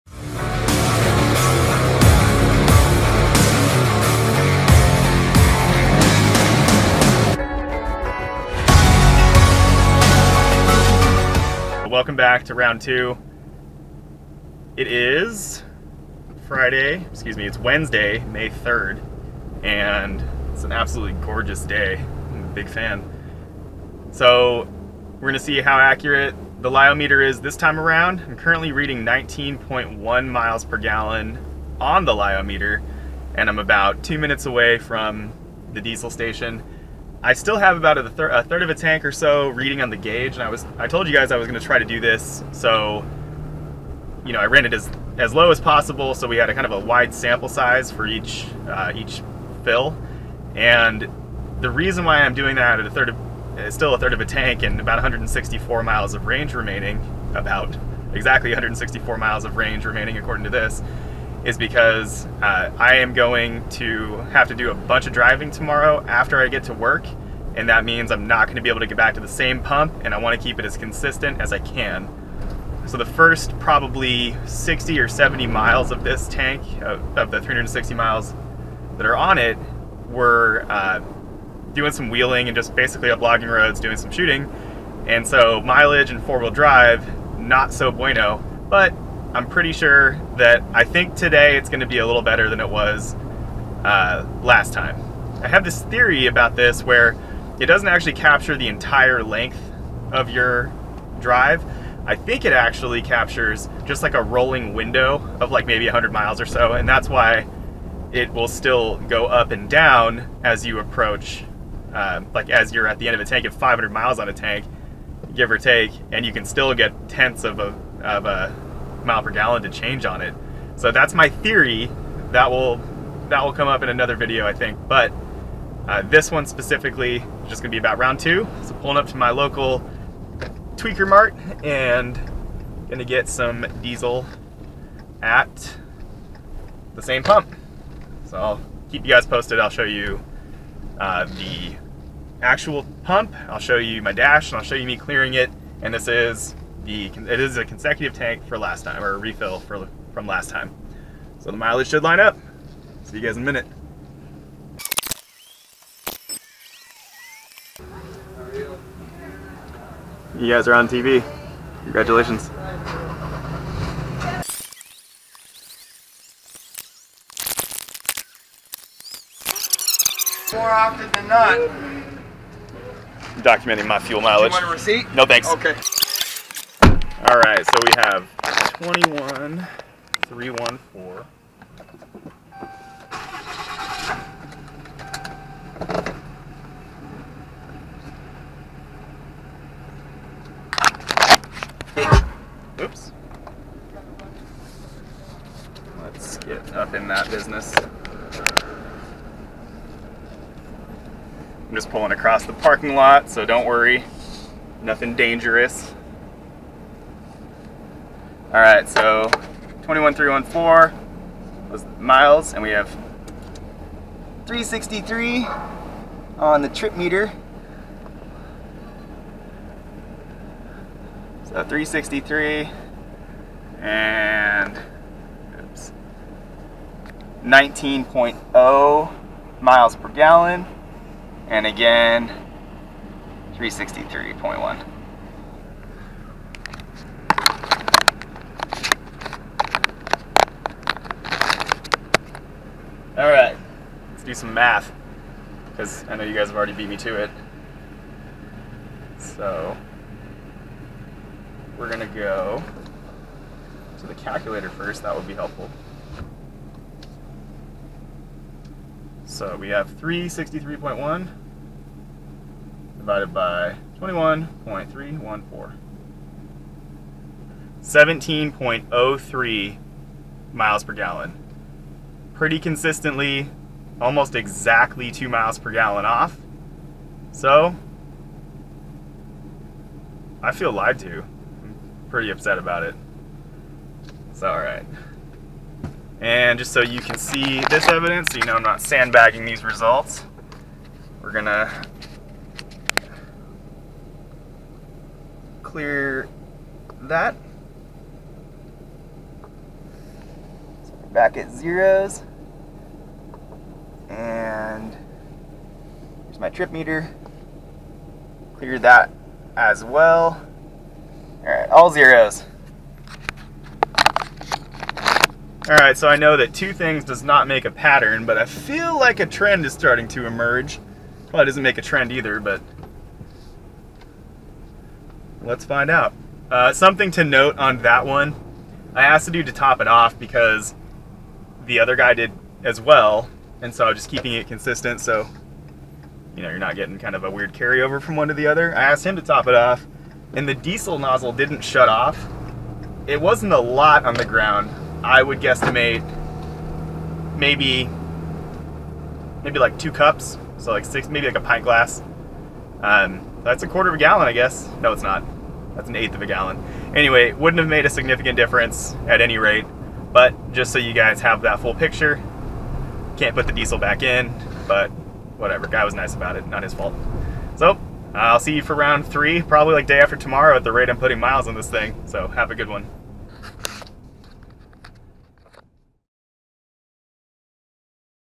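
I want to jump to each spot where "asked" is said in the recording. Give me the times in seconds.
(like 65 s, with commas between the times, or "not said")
329 s, 338 s.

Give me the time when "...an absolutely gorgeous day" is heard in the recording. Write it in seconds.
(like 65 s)
20 s.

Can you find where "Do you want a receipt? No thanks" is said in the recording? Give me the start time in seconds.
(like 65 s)
174 s.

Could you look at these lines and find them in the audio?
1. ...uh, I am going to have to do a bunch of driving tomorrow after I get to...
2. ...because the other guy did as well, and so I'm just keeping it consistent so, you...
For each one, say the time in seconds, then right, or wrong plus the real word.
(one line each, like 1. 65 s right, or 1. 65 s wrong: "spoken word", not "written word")
1. 62 s right
2. 330 s right.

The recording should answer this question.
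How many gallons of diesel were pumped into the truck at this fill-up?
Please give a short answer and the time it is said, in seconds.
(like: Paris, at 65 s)
21.314, at 178 s.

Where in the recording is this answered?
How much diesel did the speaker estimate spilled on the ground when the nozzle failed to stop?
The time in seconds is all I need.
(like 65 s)
349 s.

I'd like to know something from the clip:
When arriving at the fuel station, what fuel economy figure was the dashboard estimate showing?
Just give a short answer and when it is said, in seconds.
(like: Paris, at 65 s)
19.1 miles per gallon, at 29 s.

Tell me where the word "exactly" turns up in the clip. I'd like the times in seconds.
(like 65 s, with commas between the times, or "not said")
58 s, 274 s.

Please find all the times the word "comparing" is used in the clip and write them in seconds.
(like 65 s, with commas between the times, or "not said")
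not said.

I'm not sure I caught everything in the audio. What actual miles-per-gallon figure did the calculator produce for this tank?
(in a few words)
17.03.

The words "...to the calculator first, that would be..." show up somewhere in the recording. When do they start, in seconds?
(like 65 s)
253 s.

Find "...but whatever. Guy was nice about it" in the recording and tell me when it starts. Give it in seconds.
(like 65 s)
364 s.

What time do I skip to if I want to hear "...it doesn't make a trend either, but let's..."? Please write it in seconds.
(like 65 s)
321 s.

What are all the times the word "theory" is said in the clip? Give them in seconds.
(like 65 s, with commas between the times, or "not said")
95 s, 121 s.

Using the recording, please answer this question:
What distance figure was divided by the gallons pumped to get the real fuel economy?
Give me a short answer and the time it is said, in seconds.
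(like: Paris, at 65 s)
363.1, at 259 s.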